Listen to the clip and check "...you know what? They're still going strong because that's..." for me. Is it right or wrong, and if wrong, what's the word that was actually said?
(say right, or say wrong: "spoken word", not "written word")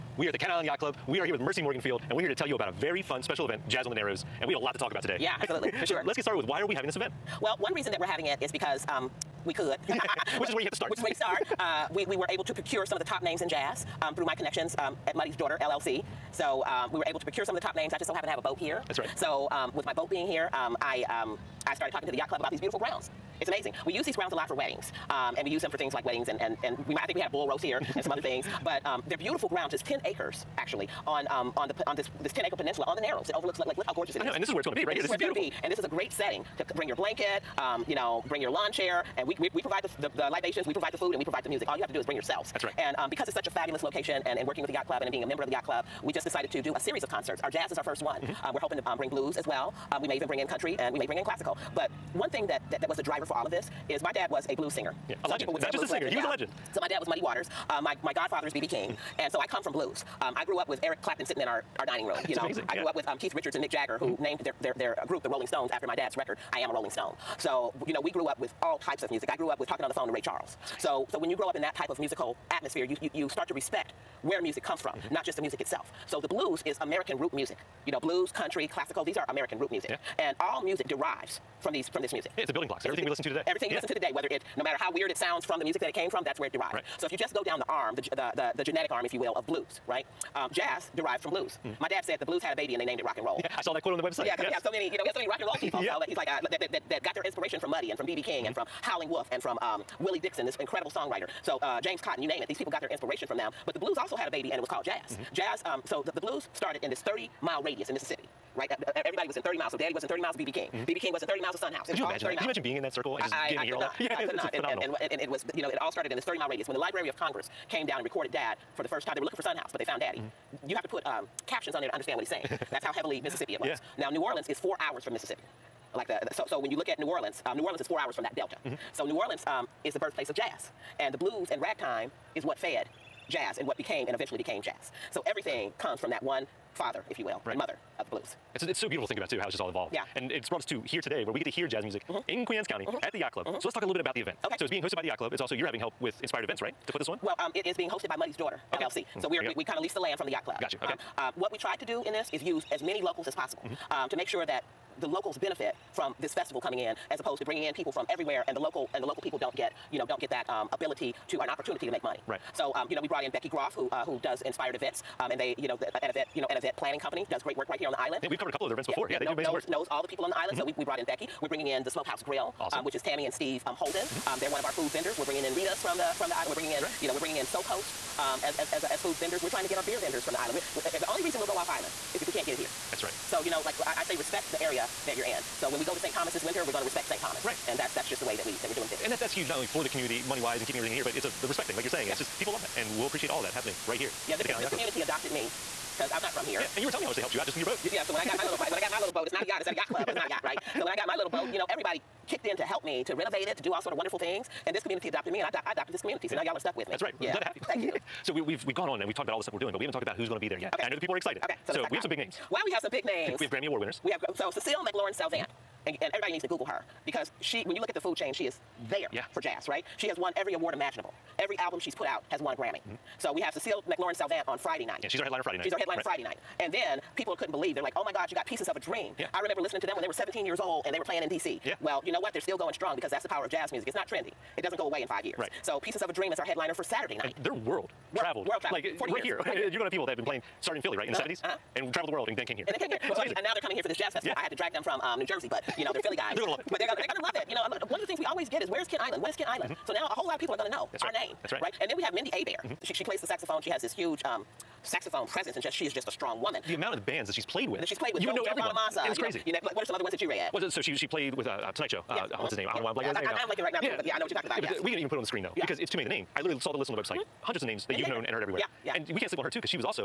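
right.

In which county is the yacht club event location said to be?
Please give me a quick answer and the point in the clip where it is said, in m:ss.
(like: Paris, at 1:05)
Queens County, at 2:22.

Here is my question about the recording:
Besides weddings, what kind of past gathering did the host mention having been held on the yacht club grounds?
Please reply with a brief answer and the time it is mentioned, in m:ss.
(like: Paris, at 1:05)
Bull roast, at 0:27.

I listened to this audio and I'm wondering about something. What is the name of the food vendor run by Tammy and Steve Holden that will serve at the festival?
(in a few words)
Smokehouse Grill.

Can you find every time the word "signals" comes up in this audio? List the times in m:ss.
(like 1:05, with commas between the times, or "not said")
not said.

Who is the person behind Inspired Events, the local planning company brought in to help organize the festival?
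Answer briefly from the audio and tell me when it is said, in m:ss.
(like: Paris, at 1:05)
Becky Groff, at 2:43.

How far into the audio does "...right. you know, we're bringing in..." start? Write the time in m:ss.
2:56.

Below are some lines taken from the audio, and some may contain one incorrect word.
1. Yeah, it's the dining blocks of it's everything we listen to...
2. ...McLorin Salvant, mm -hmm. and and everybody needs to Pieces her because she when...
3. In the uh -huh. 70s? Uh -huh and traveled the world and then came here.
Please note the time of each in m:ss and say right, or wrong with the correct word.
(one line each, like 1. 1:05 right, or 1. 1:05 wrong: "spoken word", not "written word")
1. 1:22 wrong: "building", not "dining"
2. 3:34 wrong: "Google", not "Pieces"
3. 4:01 right.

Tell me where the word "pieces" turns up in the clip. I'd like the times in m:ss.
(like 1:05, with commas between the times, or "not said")
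3:48, 3:55.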